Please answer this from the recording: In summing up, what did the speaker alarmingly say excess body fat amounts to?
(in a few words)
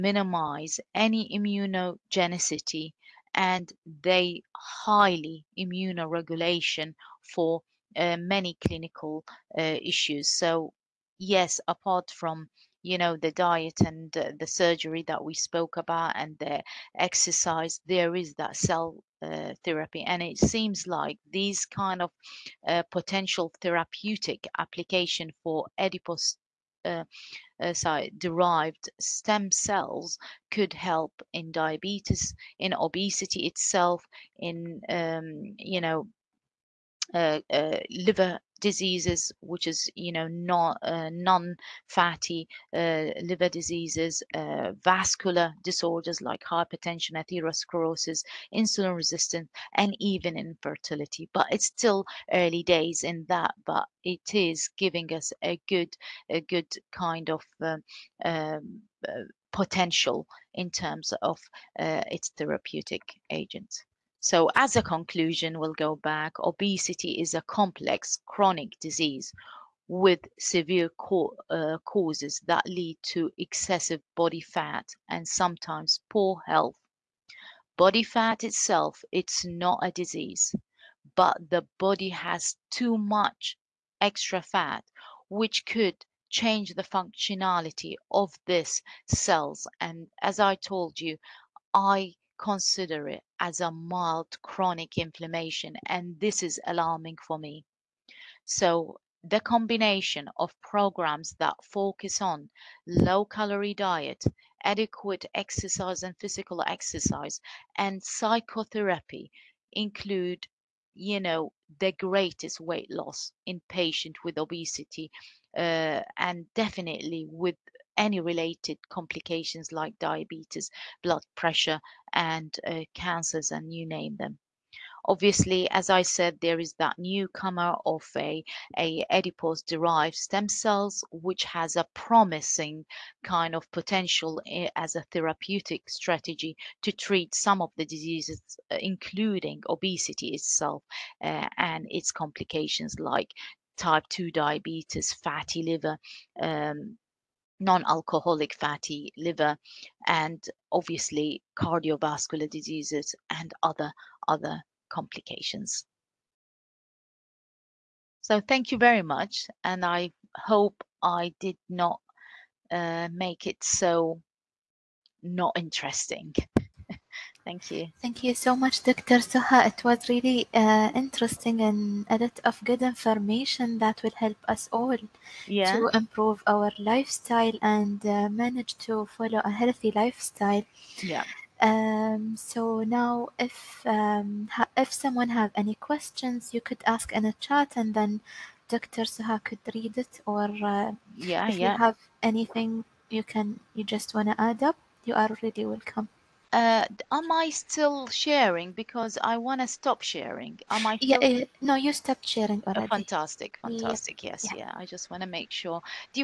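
Mild chronic inflammation.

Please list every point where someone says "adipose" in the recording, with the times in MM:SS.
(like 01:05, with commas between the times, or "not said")
00:25, 02:09.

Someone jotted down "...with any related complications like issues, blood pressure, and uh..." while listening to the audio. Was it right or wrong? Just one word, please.
wrong.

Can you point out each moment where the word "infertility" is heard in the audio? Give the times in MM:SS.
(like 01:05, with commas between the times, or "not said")
00:50.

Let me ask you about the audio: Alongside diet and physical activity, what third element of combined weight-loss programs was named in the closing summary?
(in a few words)
Psychotherapy.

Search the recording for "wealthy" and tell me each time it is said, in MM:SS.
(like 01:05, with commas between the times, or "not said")
not said.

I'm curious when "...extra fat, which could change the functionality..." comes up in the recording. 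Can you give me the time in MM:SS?
01:24.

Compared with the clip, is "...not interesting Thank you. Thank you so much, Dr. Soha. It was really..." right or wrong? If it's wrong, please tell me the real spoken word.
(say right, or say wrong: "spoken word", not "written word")
right.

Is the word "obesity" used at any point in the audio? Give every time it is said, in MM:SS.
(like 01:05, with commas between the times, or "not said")
00:32, 01:06, 01:54, 02:19.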